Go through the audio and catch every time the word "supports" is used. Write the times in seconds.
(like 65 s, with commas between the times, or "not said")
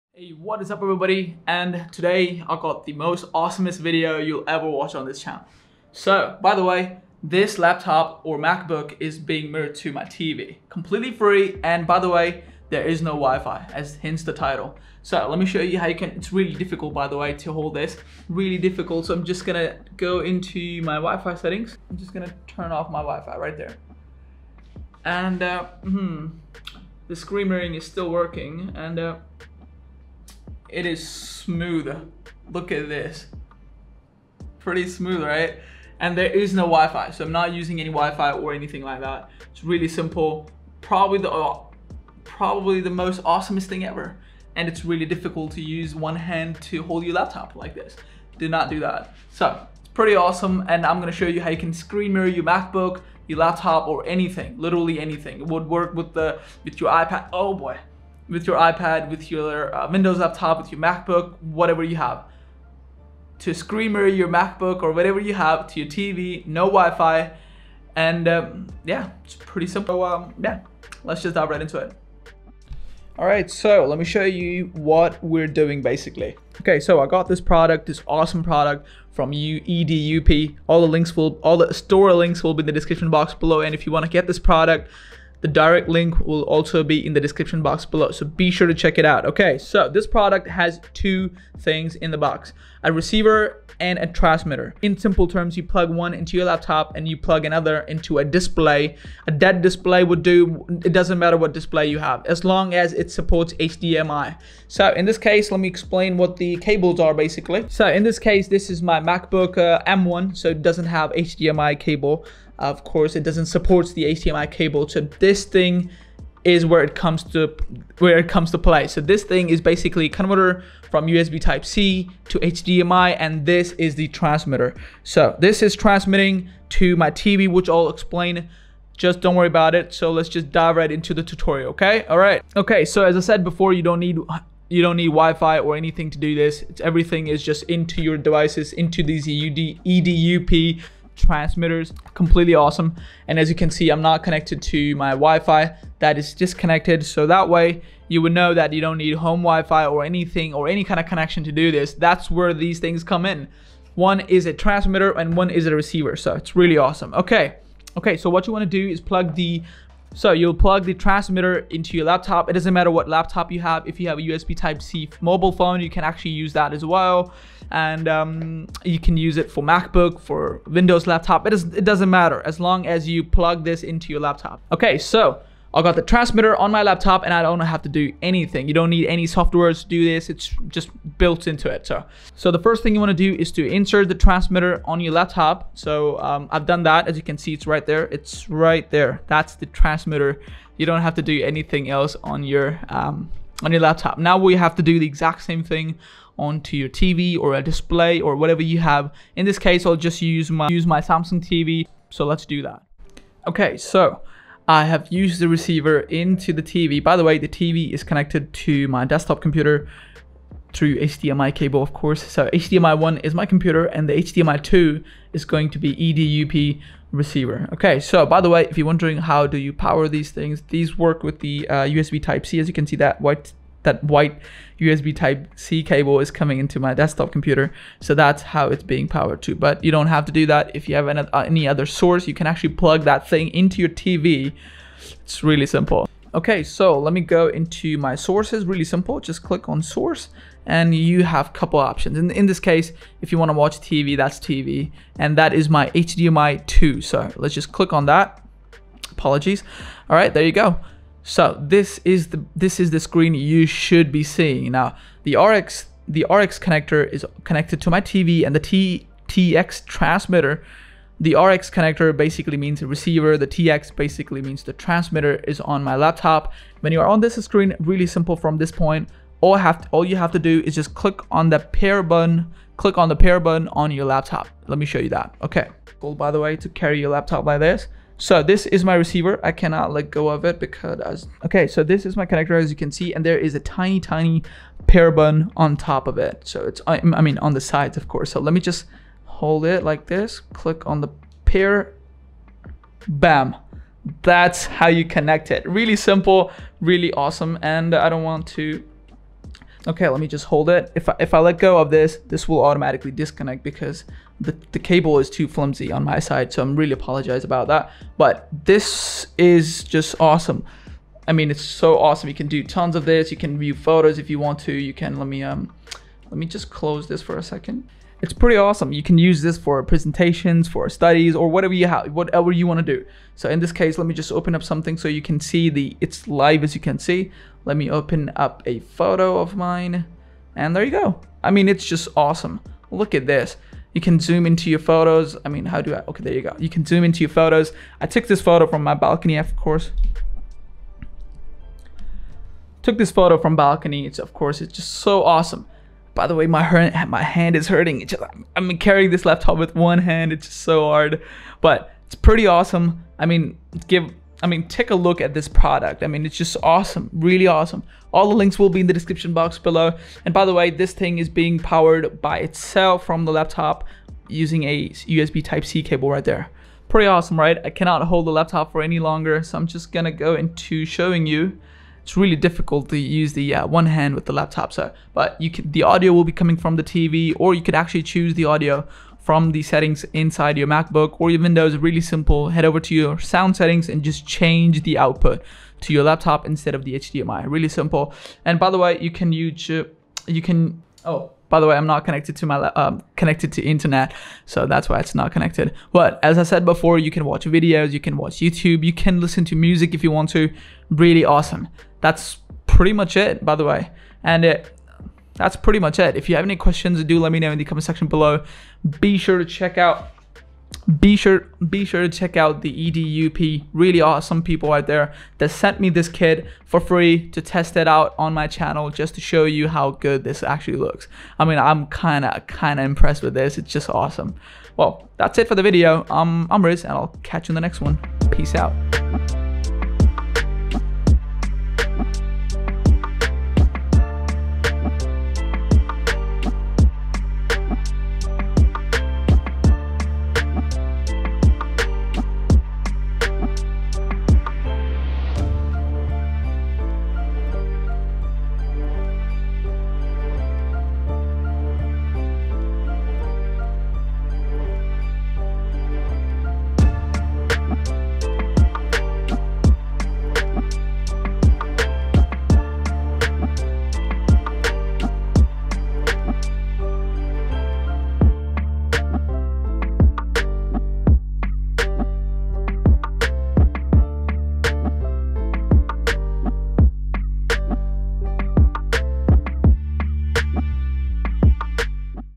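103 s, 113 s.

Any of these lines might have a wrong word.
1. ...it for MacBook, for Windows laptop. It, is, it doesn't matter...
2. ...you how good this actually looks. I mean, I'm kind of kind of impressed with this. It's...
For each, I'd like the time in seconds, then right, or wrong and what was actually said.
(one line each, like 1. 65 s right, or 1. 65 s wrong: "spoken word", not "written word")
1. 169 s right
2. 419 s right.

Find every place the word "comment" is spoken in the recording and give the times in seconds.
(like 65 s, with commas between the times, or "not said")
407 s.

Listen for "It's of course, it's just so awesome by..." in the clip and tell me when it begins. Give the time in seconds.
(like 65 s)
344 s.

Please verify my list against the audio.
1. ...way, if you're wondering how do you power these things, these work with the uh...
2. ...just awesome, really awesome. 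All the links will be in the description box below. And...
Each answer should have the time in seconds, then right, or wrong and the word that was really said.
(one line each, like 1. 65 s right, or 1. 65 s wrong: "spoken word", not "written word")
1. 218 s right
2. 356 s right.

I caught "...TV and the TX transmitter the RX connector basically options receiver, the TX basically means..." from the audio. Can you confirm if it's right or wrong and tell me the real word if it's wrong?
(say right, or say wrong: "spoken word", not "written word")
wrong: "means", not "options".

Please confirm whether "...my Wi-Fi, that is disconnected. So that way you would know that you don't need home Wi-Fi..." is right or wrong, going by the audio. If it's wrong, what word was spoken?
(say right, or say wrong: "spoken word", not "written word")
right.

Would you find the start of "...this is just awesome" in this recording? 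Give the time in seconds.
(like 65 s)
308 s.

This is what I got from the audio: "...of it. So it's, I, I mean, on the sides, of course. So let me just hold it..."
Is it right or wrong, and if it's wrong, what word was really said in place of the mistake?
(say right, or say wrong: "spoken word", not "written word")
right.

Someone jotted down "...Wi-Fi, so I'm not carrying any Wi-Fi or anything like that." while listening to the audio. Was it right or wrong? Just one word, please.
wrong.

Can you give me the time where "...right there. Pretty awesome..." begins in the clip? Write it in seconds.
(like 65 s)
366 s.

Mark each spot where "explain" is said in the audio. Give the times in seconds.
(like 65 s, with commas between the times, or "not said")
105 s, 127 s.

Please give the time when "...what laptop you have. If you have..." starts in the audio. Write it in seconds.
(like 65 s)
162 s.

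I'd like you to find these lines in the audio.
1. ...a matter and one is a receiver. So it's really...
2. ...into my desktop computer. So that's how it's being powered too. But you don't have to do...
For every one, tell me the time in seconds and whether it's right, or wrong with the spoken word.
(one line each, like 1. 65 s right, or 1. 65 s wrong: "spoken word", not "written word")
1. 154 s wrong: "transmitter", not "matter"
2. 226 s right.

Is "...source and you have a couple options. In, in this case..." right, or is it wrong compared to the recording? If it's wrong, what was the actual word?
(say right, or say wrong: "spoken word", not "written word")
right.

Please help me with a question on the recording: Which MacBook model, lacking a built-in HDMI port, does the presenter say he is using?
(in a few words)
M1.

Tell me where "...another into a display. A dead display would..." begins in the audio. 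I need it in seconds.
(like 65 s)
97 s.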